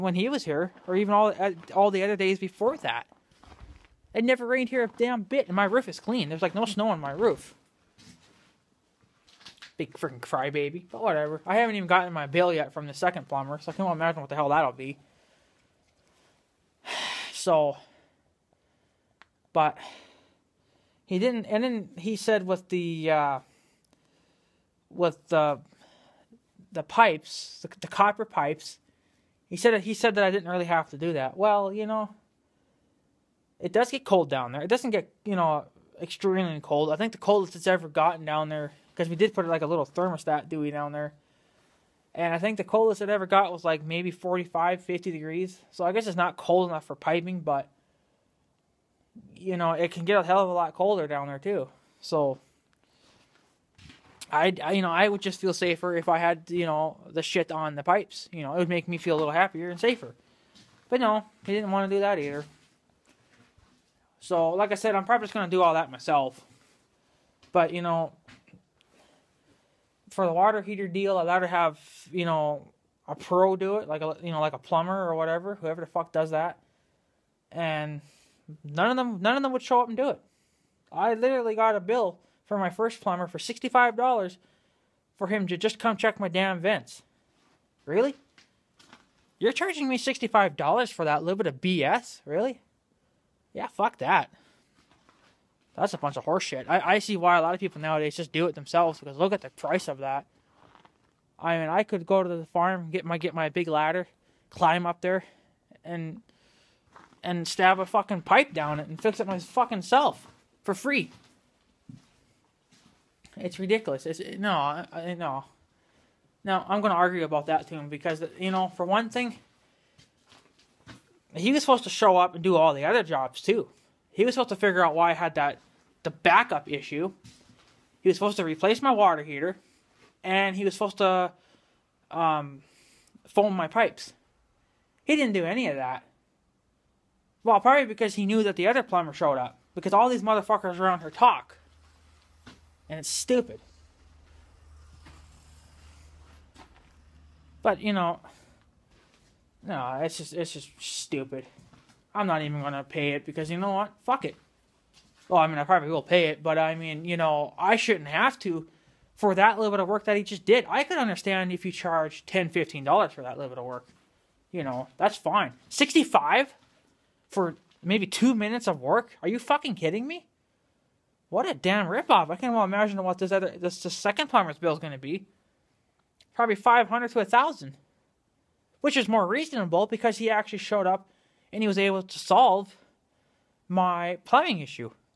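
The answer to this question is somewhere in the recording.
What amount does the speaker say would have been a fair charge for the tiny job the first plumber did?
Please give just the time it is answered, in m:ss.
2:42.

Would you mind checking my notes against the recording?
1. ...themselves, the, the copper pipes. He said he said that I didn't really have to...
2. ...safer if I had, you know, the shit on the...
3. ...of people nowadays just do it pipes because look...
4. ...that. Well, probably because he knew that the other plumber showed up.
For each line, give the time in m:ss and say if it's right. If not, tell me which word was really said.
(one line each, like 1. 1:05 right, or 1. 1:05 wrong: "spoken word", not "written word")
1. 0:26 wrong: "pipes", not "themselves"
2. 0:55 right
3. 1:37 wrong: "themselves", not "pipes"
4. 2:15 right.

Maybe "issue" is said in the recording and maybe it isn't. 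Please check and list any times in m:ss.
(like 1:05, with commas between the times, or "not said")
2:06, 3:04.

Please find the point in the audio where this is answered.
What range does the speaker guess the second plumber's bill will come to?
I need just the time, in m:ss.
2:56.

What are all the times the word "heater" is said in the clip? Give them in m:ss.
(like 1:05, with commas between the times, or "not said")
1:10, 2:09.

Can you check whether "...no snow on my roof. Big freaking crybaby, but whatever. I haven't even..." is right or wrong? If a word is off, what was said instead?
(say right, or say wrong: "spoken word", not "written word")
right.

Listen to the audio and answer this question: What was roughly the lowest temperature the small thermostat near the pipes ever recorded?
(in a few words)
45 to 50 degrees.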